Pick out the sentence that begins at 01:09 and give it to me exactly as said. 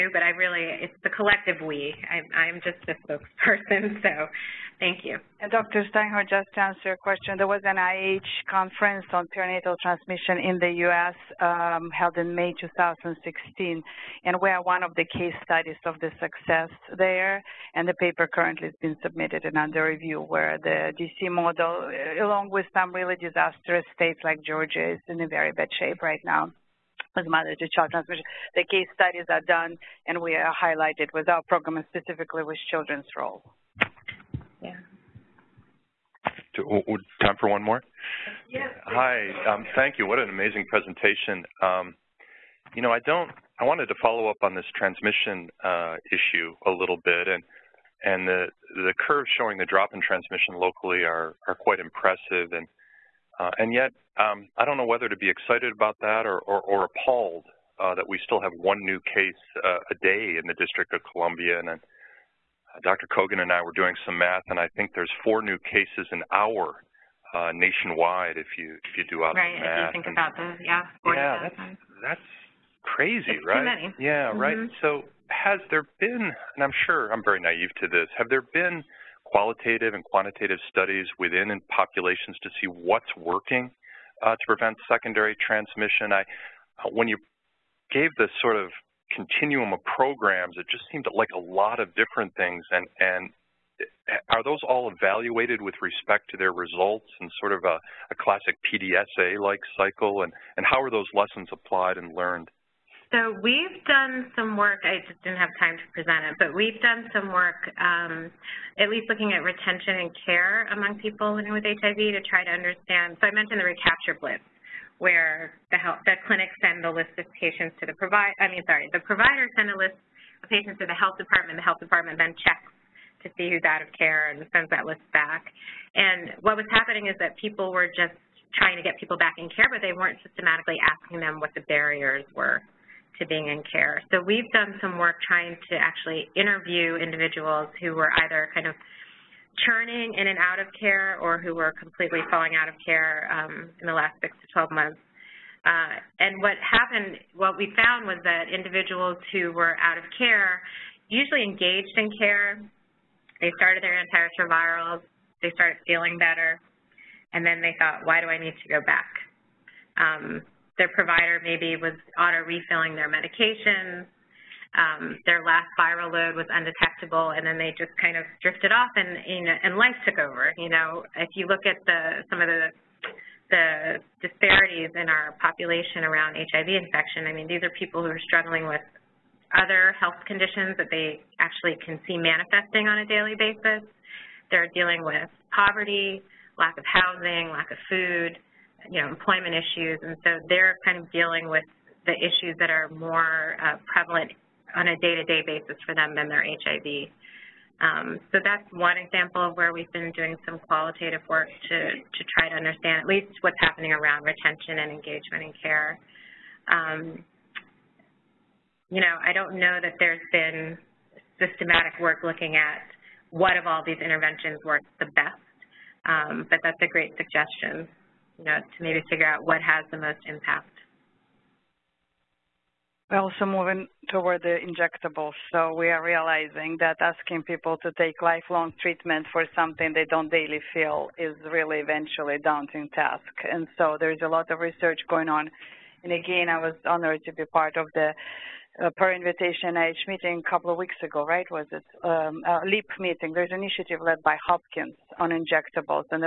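Right, if you think and, about those, yeah.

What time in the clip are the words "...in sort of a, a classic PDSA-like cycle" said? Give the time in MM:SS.
01:37.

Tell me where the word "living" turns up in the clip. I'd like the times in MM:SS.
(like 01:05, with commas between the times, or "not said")
01:51.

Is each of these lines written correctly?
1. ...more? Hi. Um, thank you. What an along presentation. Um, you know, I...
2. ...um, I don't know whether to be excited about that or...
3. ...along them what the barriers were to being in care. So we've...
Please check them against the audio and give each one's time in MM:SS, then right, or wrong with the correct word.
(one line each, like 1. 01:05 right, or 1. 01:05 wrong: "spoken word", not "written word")
1. 00:37 wrong: "amazing", not "along"
2. 00:54 right
3. 02:10 wrong: "asking", not "along".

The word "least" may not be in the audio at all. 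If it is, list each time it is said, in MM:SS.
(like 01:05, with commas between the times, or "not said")
01:48, 03:23.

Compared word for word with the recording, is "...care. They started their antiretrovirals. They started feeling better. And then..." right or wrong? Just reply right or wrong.
right.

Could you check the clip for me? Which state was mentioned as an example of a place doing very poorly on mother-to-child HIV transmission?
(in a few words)
Georgia.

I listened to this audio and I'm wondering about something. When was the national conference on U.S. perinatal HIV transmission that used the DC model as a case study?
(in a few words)
May 2016.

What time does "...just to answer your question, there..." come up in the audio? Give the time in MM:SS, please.
00:06.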